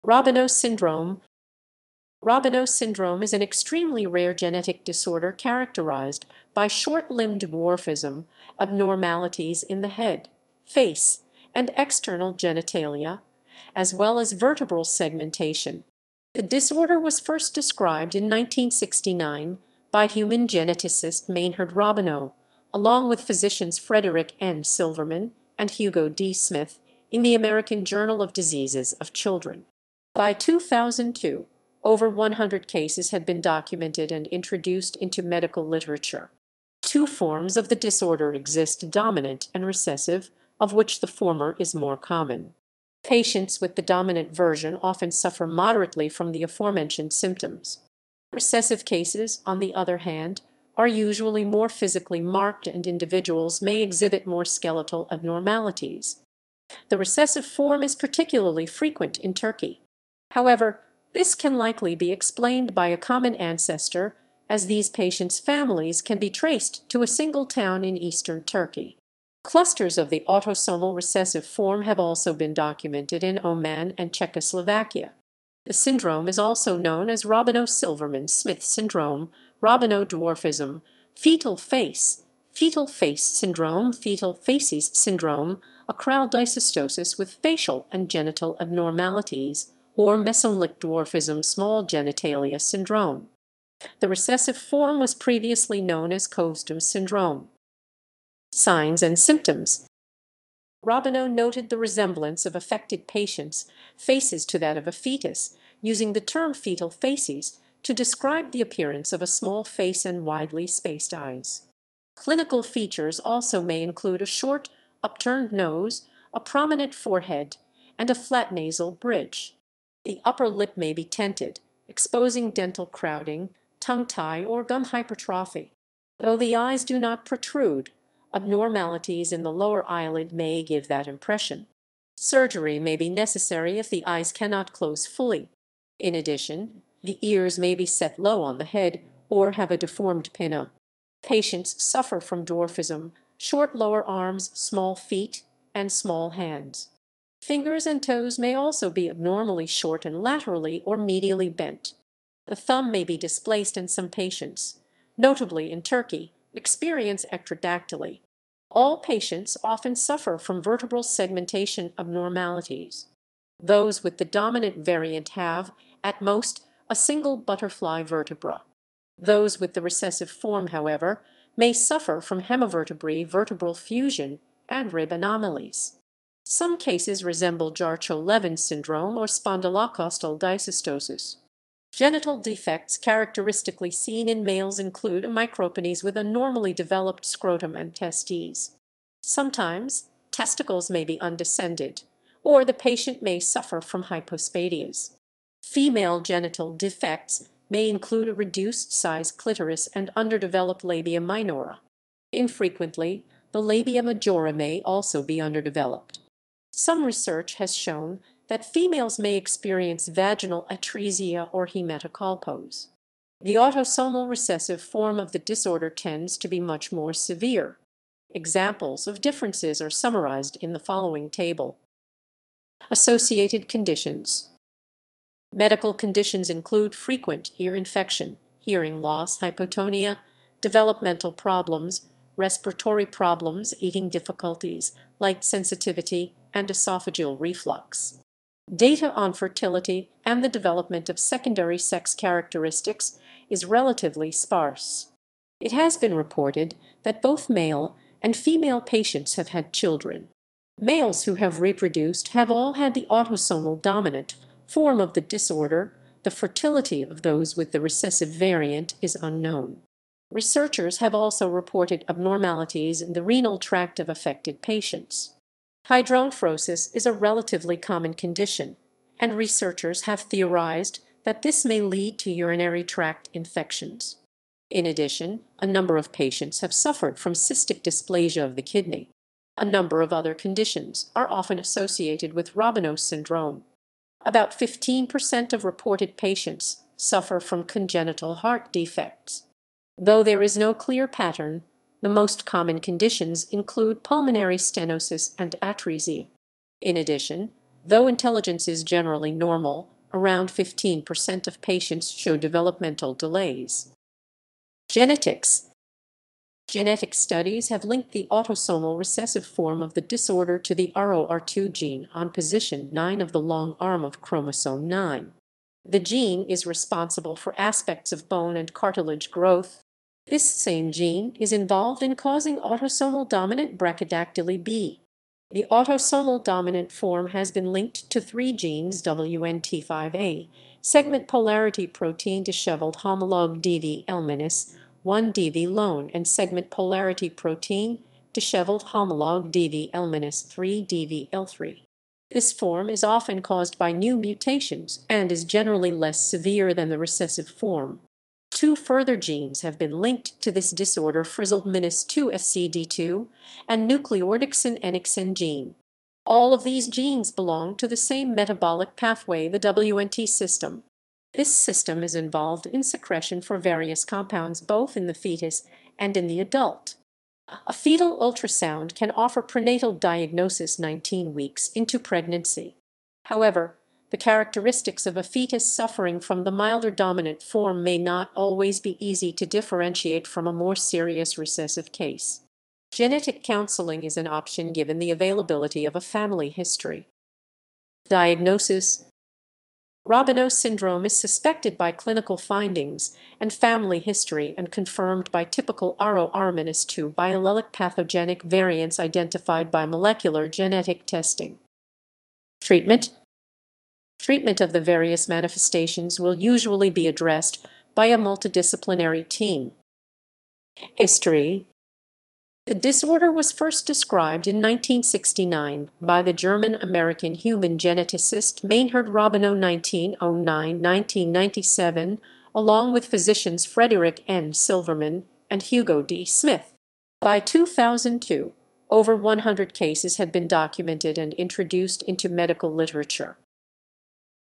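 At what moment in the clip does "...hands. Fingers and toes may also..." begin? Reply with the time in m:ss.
2:26.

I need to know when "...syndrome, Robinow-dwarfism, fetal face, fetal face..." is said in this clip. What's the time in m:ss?
1:18.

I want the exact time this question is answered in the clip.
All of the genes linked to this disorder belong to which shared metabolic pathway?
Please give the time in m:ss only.
5:59.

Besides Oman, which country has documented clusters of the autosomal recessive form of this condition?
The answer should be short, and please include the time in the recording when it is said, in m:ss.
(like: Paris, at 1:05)
Czechoslovakia, at 1:14.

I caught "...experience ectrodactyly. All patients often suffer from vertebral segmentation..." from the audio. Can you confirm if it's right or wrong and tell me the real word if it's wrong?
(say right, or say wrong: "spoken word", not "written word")
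right.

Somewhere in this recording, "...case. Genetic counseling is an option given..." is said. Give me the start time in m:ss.
6:21.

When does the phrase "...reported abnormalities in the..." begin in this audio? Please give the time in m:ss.
4:21.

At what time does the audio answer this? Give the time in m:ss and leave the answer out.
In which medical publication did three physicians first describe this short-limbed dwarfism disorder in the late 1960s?
0:27.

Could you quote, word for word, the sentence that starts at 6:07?
A fetal ultrasound can offer prenatal diagnosis 19 weeks into pregnancy.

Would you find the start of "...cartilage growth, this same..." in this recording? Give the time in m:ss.
5:18.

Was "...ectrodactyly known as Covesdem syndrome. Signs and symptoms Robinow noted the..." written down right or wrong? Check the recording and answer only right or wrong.
wrong.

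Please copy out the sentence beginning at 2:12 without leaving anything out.
Surgery may be necessary if the eyes cannot close fully.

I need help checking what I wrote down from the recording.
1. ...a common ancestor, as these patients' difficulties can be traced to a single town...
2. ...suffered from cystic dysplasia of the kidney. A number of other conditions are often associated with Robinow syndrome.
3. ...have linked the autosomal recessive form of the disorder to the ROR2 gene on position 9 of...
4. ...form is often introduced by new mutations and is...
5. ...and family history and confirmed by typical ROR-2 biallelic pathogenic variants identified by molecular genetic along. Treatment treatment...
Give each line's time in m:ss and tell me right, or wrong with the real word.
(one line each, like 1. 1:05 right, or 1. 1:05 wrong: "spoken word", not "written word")
1. 1:02 wrong: "families", not "difficulties"
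2. 4:36 right
3. 5:07 right
4. 5:42 wrong: "caused", not "introduced"
5. 6:33 wrong: "testing", not "along".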